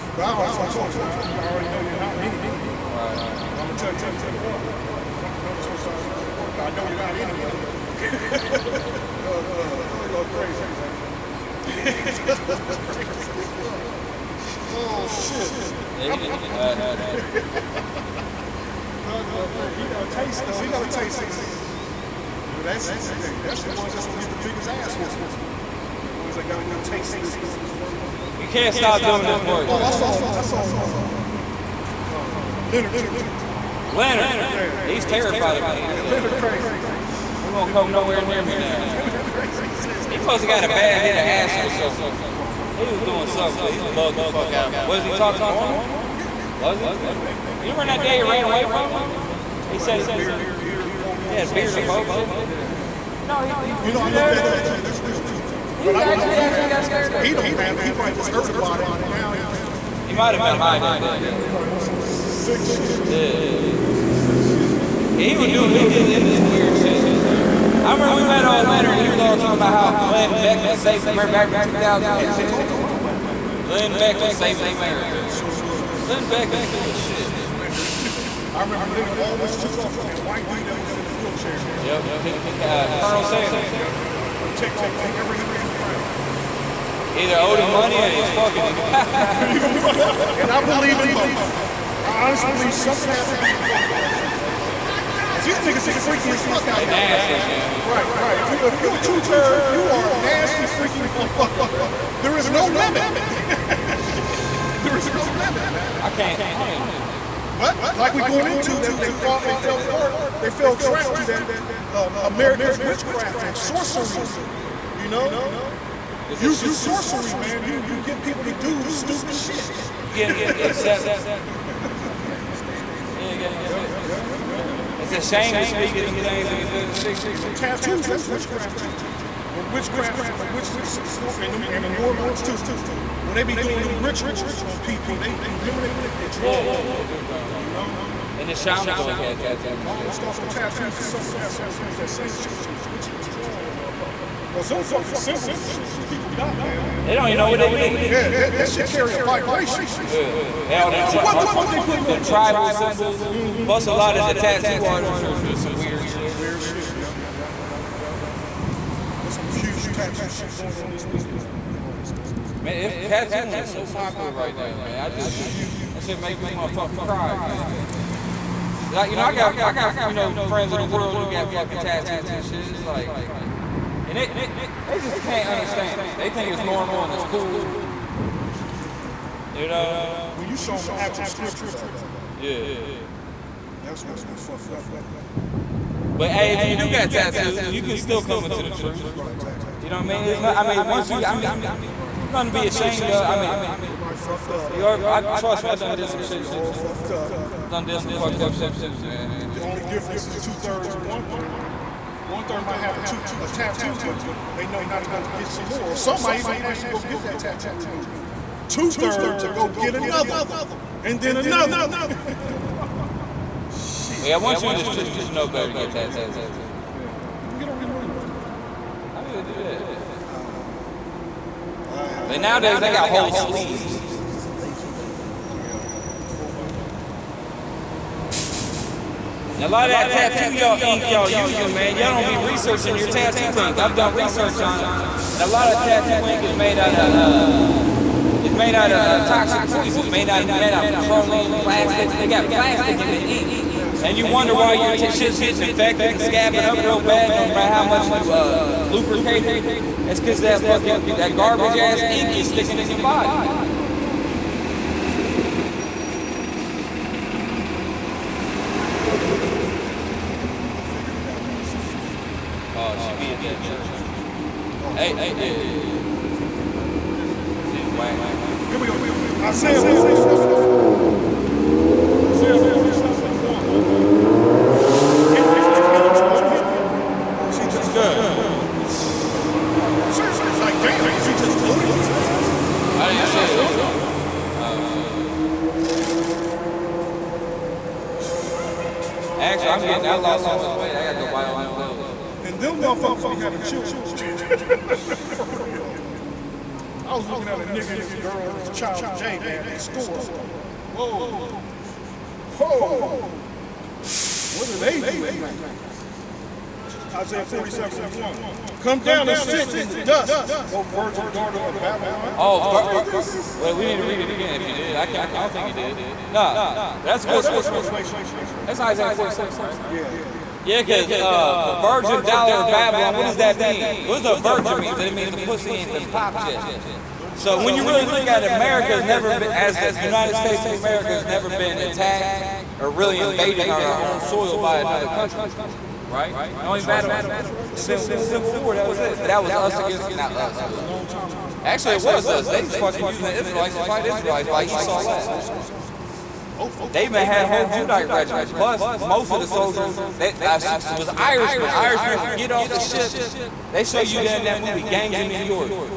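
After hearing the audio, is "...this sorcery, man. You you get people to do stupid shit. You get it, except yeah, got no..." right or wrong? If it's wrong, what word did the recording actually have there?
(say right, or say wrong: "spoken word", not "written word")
right.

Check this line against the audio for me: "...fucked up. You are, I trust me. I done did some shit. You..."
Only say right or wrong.
right.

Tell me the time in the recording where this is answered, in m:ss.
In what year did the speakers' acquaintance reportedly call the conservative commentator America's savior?
1:11.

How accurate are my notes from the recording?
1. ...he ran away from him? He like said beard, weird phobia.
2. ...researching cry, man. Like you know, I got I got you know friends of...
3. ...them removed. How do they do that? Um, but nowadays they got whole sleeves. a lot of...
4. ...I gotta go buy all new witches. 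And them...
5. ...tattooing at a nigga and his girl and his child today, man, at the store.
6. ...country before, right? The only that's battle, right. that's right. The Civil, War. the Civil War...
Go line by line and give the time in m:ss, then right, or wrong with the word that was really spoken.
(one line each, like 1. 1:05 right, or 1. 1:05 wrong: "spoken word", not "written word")
1. 0:48 wrong: "beard", not "weird"
2. 2:46 wrong: "fucking", not "researching"
3. 3:37 right
4. 4:50 wrong: "clothes", not "witches"
5. 4:57 wrong: "looking", not "tattooing"
6. 5:35 right.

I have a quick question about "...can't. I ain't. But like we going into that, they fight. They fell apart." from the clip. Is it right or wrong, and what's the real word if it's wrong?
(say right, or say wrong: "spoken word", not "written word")
wrong: "fought", not "fight".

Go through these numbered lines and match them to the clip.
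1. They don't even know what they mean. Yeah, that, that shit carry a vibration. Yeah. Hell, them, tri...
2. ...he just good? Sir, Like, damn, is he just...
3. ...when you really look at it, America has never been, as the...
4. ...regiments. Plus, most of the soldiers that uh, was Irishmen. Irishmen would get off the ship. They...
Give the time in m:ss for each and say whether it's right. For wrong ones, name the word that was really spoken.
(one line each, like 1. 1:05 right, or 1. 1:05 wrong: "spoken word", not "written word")
1. 2:27 right
2. 4:37 right
3. 5:27 right
4. 5:48 right.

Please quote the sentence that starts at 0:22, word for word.
Well, that's that's the ones that's gonna get the biggest ass whooping.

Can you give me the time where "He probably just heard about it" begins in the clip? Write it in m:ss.
0:57.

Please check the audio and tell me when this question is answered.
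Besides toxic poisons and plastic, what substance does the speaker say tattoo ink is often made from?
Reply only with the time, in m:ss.
4:00.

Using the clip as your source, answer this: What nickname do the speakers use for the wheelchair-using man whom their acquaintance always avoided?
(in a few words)
Colonel Sanders.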